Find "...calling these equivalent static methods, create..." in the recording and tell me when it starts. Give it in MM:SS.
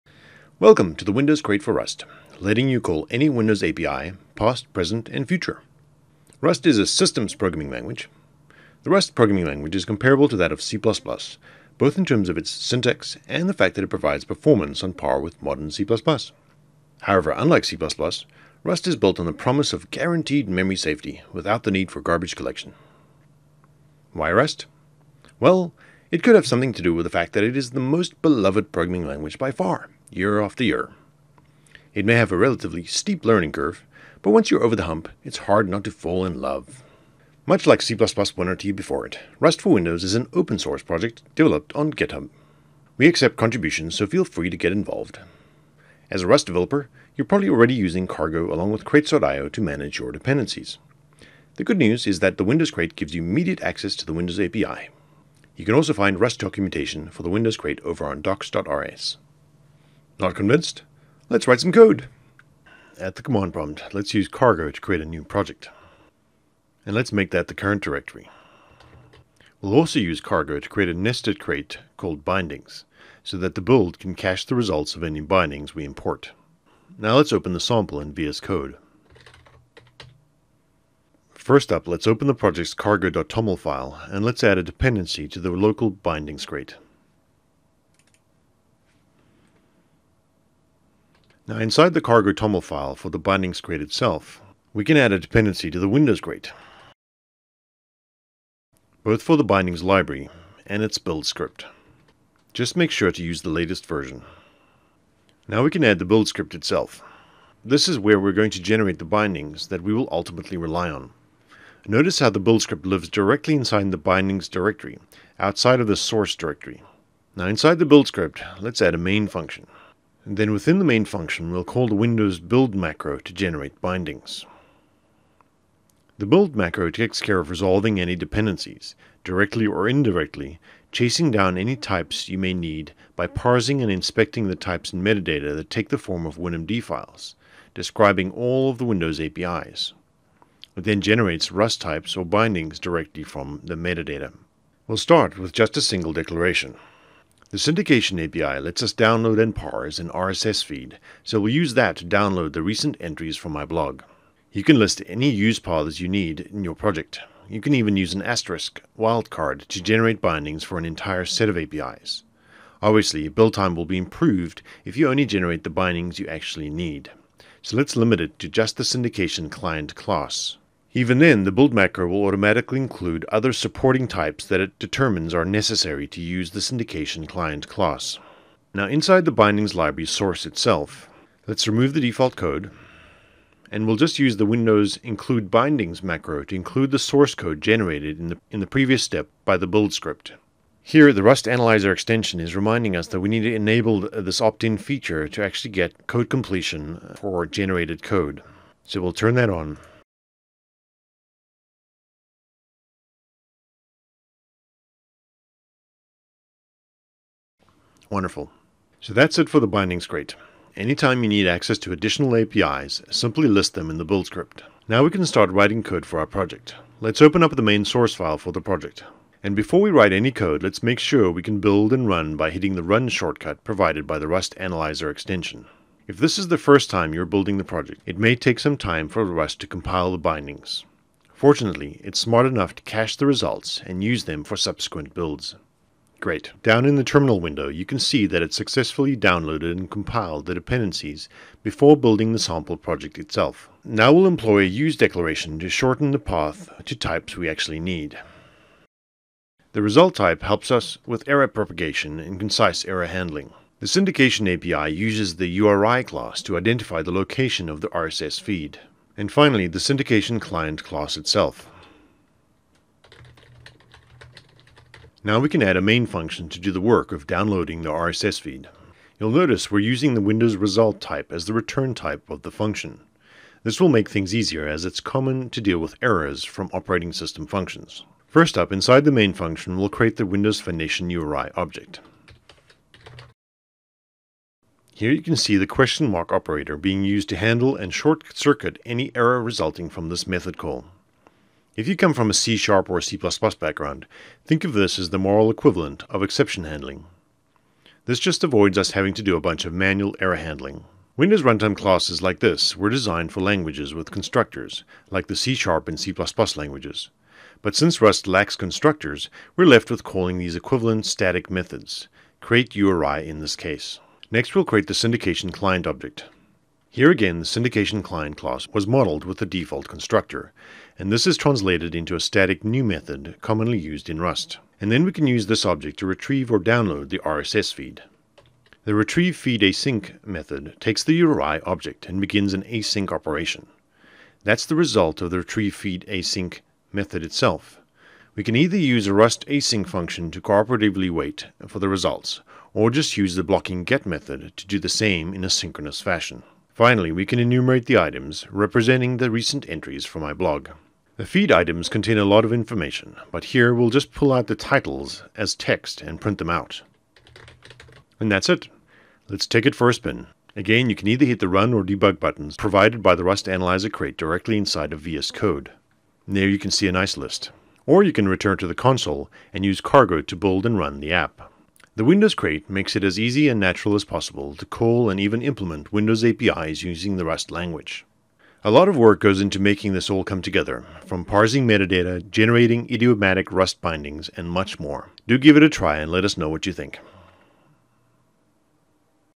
05:10.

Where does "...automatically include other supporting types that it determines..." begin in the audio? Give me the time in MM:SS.
02:52.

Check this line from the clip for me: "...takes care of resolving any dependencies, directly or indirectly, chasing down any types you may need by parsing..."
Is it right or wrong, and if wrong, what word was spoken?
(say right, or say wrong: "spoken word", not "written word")
right.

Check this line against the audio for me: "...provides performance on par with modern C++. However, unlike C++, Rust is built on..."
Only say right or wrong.
right.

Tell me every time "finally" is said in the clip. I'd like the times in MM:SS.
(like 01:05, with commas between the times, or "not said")
04:19, 05:46.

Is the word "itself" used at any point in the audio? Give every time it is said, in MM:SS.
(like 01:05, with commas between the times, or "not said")
01:33, 01:46, 03:00, 04:03, 04:21, 05:37.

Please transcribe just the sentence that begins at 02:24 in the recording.
We'll start with just a single declaration.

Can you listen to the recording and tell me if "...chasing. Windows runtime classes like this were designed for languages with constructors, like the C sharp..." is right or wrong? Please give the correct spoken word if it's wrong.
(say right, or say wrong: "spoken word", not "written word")
wrong: "handling", not "chasing".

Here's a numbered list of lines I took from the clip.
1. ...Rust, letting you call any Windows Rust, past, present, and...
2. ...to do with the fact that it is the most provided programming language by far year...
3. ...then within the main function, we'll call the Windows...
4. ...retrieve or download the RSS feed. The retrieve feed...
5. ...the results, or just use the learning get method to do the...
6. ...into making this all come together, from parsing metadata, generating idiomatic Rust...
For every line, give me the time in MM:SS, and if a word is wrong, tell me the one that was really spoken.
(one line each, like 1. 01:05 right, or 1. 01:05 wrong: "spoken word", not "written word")
1. 00:01 wrong: "API", not "Rust"
2. 00:26 wrong: "beloved", not "provided"
3. 02:00 right
4. 05:26 right
5. 05:41 wrong: "blocking", not "learning"
6. 06:19 right.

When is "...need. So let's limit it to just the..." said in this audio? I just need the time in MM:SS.
02:46.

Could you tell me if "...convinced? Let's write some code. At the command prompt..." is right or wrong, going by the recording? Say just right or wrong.
right.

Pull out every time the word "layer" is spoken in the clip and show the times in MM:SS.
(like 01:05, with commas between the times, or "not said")
not said.